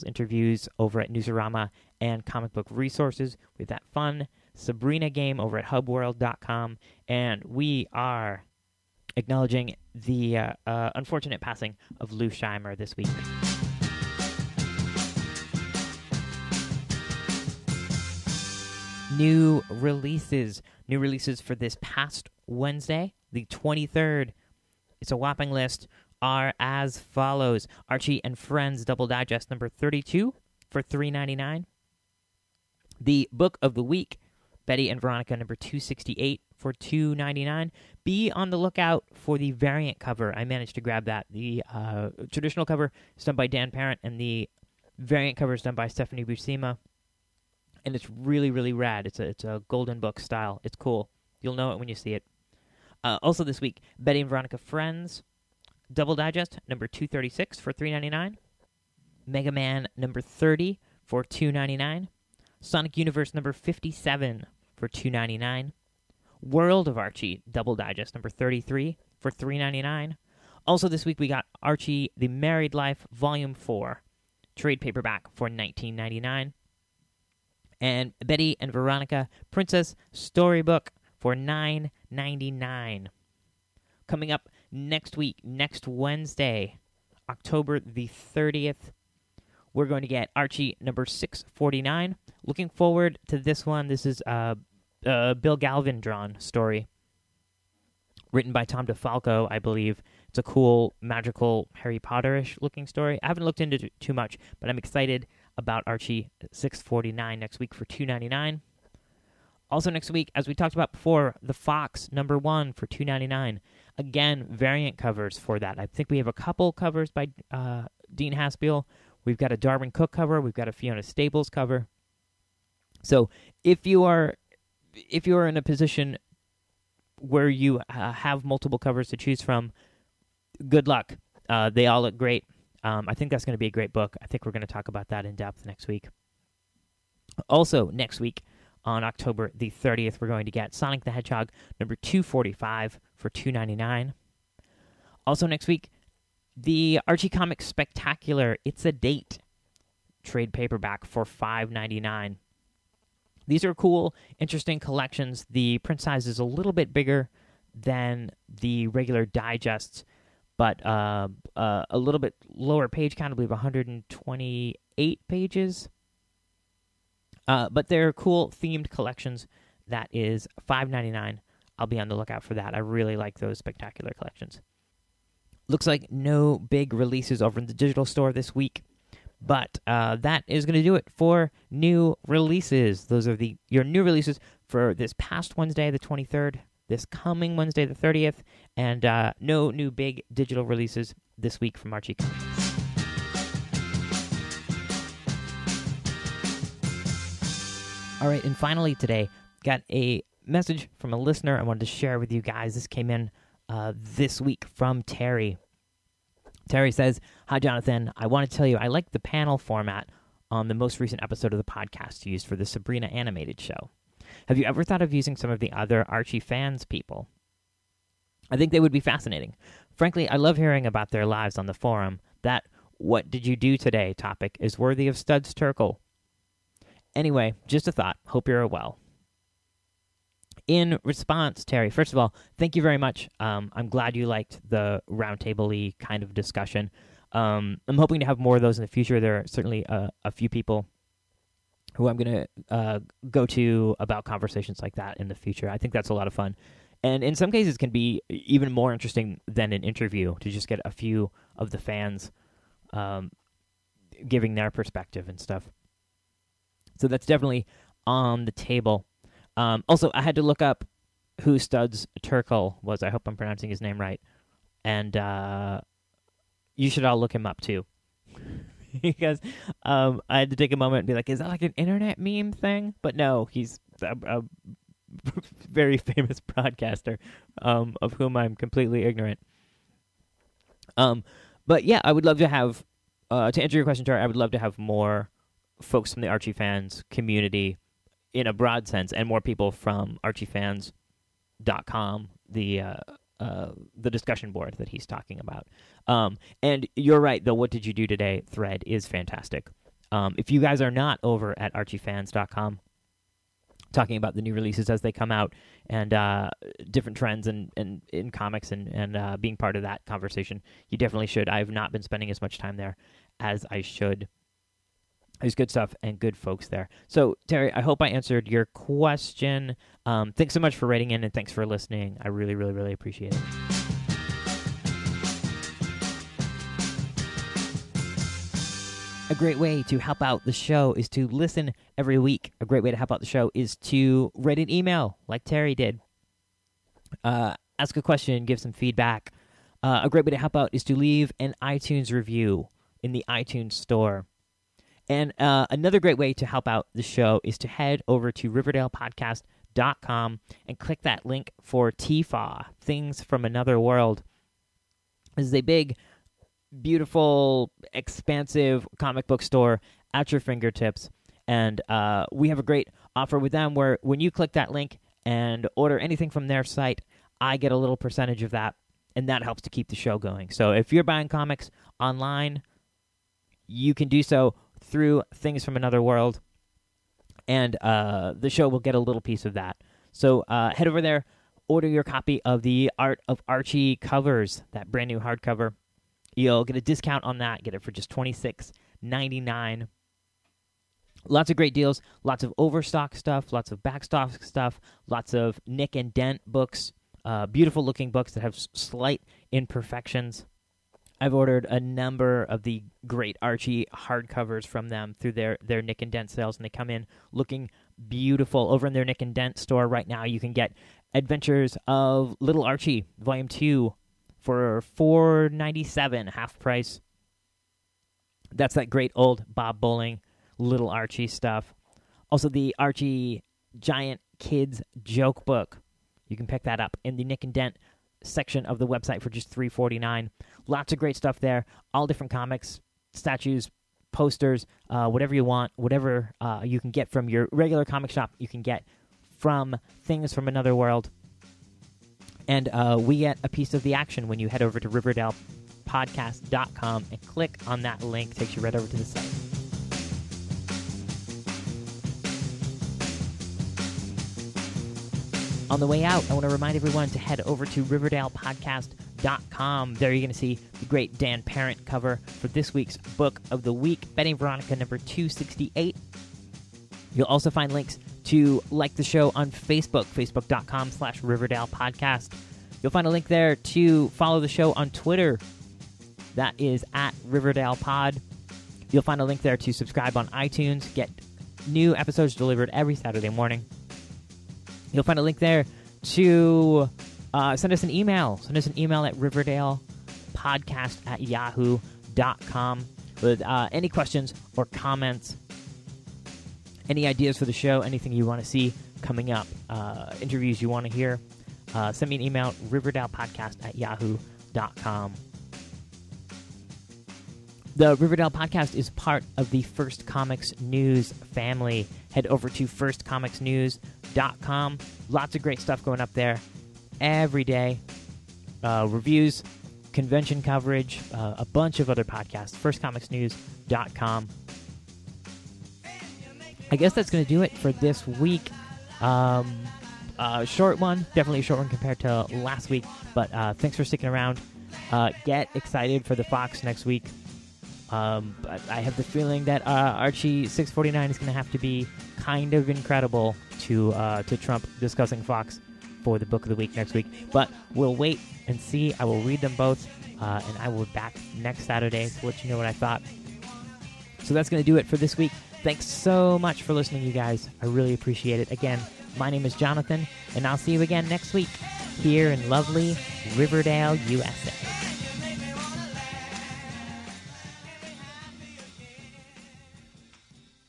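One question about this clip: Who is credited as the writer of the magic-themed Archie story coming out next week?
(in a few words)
Tom DeFalco.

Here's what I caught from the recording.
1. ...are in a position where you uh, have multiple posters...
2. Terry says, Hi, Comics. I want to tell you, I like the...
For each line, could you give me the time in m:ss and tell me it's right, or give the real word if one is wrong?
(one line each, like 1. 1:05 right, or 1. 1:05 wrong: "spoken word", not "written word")
1. 2:05 wrong: "covers", not "posters"
2. 3:26 wrong: "Jonathan", not "Comics".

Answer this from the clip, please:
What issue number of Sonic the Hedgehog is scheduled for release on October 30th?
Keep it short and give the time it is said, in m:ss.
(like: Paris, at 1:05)
245, at 2:21.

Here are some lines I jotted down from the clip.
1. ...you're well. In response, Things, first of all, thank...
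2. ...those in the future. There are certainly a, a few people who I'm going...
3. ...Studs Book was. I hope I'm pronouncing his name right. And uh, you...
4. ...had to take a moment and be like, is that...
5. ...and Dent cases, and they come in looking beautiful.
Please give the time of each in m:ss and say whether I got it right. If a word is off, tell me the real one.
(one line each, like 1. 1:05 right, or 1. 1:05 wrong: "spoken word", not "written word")
1. 3:48 wrong: "Terry", not "Things"
2. 3:58 right
3. 4:21 wrong: "Terkel", not "Book"
4. 4:30 right
5. 6:46 wrong: "sales", not "cases".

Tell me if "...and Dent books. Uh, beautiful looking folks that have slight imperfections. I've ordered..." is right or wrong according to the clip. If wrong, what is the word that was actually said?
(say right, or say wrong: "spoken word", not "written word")
wrong: "books", not "folks".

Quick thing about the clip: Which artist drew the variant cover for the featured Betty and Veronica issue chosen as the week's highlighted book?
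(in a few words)
Stephanie Buscema.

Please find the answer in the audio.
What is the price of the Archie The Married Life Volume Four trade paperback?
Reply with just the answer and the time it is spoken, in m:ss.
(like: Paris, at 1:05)
$19.99, at 1:15.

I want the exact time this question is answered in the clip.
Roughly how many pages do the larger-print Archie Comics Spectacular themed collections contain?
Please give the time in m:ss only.
2:43.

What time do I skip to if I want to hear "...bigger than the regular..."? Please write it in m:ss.
2:36.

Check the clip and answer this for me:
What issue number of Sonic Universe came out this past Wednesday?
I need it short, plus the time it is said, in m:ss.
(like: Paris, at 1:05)
57, at 1:03.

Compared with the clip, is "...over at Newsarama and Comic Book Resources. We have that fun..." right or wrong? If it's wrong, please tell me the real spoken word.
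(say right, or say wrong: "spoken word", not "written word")
right.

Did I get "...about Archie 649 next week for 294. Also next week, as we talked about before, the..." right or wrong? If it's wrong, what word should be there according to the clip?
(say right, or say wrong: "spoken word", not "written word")
wrong: "299", not "294".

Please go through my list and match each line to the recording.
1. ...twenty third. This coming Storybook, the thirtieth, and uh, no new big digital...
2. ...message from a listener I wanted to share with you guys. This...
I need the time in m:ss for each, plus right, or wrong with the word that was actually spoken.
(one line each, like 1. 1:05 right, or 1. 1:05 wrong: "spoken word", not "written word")
1. 3:05 wrong: "Wednesday", not "Storybook"
2. 3:20 right.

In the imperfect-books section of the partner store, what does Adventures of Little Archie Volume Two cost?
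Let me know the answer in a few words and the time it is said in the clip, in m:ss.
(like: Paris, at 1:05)
$4.97, at 6:54.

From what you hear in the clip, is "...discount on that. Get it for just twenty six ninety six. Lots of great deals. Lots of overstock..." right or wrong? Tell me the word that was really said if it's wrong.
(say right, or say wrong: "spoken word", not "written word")
wrong: "nine", not "six".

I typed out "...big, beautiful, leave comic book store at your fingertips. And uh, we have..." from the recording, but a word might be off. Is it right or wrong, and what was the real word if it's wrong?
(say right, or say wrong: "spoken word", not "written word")
wrong: "expansive", not "leave".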